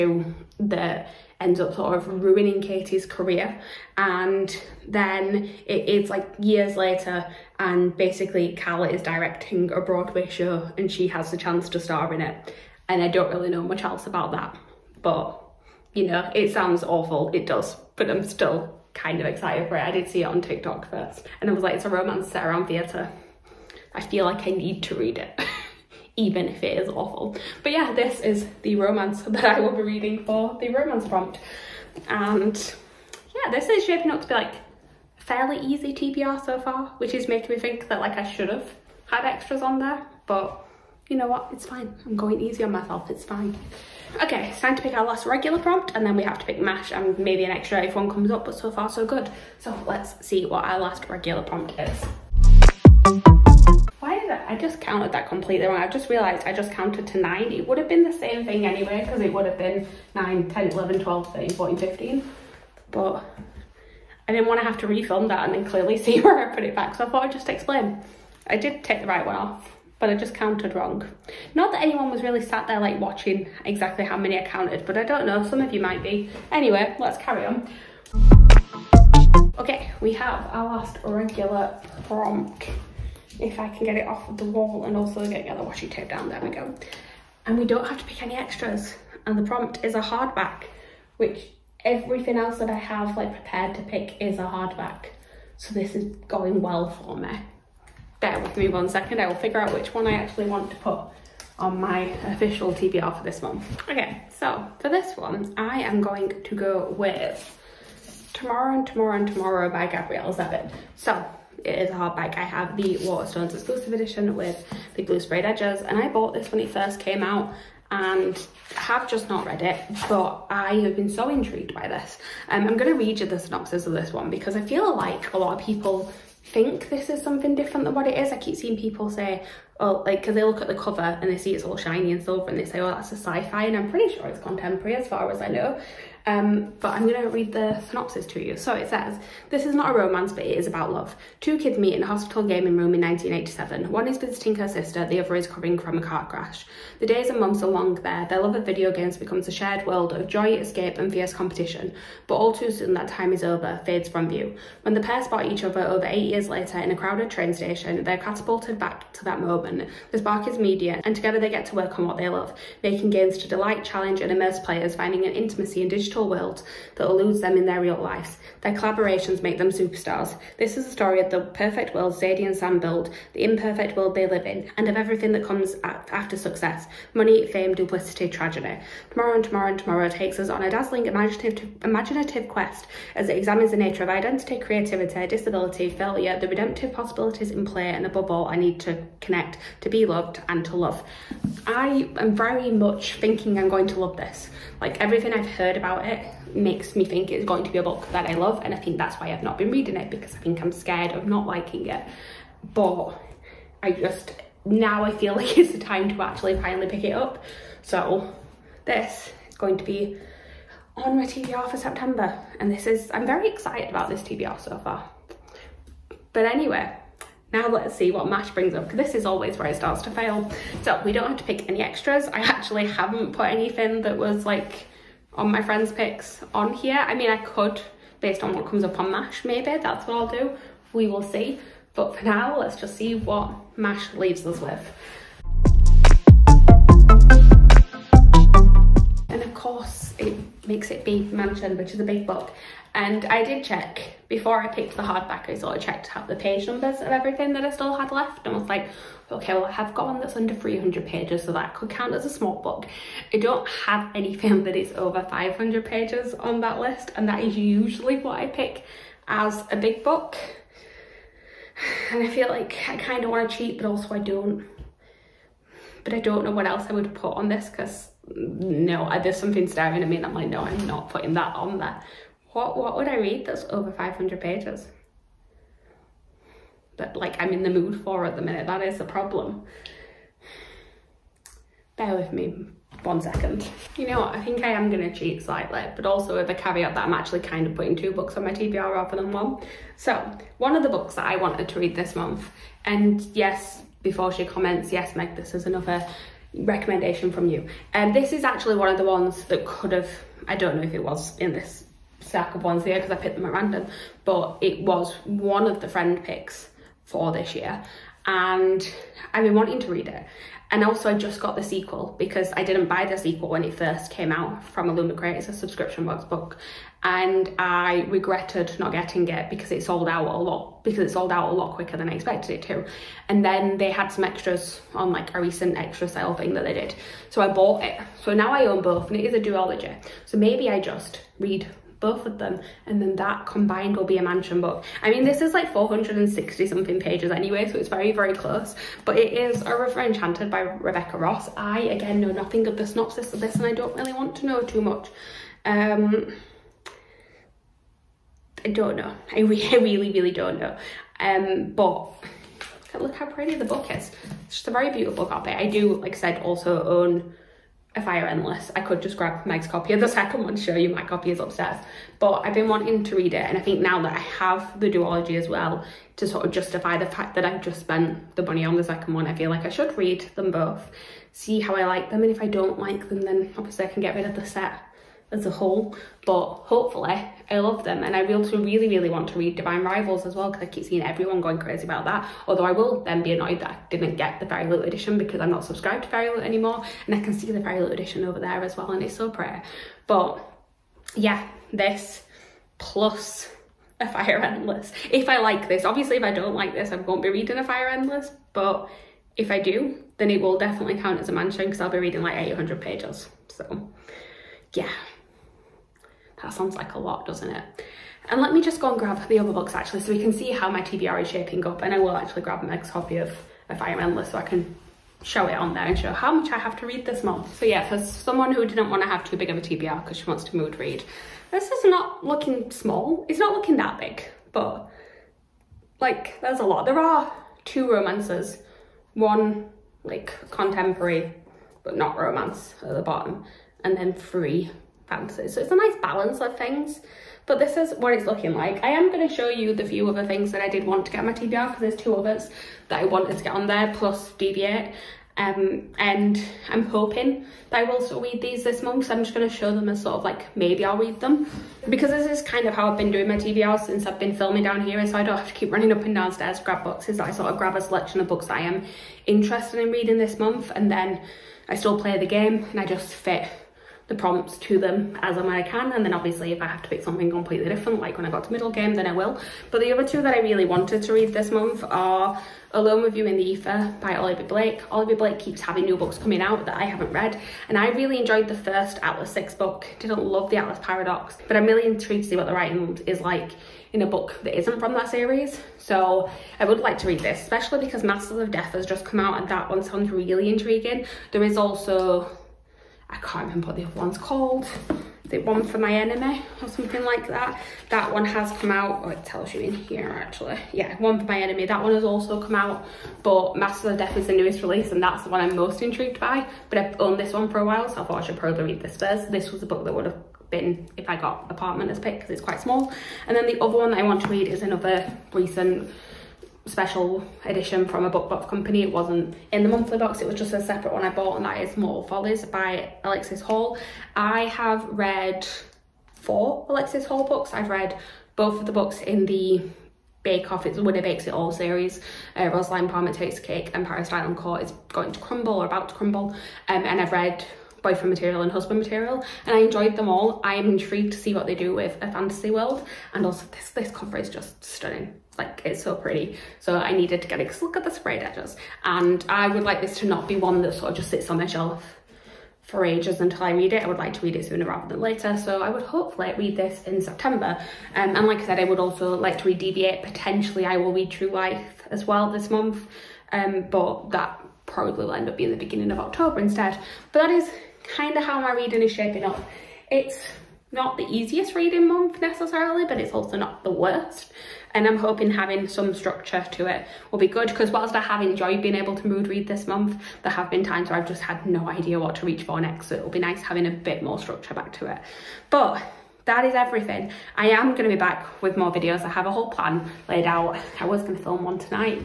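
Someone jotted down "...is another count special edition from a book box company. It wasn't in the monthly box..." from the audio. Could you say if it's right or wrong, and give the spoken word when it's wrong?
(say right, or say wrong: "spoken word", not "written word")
wrong: "recent", not "count".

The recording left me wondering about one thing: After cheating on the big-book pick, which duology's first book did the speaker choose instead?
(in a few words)
A River Enchanted.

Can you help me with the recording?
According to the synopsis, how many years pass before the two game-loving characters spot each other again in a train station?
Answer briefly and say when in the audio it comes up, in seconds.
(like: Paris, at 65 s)
8, at 156 s.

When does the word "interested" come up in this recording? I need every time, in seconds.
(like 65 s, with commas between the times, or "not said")
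459 s.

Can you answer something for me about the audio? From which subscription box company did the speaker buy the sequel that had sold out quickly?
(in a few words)
Illumicrate.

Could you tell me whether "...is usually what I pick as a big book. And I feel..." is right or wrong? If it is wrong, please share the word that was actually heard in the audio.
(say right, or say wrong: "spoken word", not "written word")
right.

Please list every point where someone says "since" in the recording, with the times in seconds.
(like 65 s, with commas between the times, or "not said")
453 s.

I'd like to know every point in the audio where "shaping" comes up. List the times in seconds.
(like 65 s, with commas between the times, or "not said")
33 s, 411 s, 568 s.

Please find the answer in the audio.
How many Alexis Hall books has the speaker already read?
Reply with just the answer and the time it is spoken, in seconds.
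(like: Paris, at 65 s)
4, at 526 s.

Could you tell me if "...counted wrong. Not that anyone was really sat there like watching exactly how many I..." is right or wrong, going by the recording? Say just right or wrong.
right.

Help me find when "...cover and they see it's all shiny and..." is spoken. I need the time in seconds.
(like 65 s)
130 s.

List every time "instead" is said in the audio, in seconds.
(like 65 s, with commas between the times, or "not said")
566 s.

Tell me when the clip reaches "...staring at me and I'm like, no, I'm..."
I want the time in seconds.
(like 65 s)
269 s.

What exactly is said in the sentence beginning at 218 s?
This is always where it starts to fail.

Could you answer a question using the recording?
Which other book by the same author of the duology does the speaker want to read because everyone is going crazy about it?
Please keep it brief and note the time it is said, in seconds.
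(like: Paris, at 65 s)
Divine Rivals, at 379 s.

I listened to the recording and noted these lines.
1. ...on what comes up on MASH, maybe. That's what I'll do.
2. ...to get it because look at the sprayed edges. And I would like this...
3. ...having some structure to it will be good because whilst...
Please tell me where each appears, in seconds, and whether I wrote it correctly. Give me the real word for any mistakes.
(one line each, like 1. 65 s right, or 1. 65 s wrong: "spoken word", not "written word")
1. 228 s right
2. 547 s right
3. 575 s right.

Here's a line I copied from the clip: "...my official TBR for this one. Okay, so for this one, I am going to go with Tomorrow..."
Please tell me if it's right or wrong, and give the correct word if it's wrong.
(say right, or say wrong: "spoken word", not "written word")
right.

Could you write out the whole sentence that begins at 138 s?
So it says, This is not a romance, but it is about love.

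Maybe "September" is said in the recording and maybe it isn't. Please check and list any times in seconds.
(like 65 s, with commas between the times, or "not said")
211 s, 556 s.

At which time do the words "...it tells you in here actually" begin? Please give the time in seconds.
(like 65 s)
499 s.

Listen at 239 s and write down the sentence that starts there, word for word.
And of course it makes it be Mansion, which is a big book.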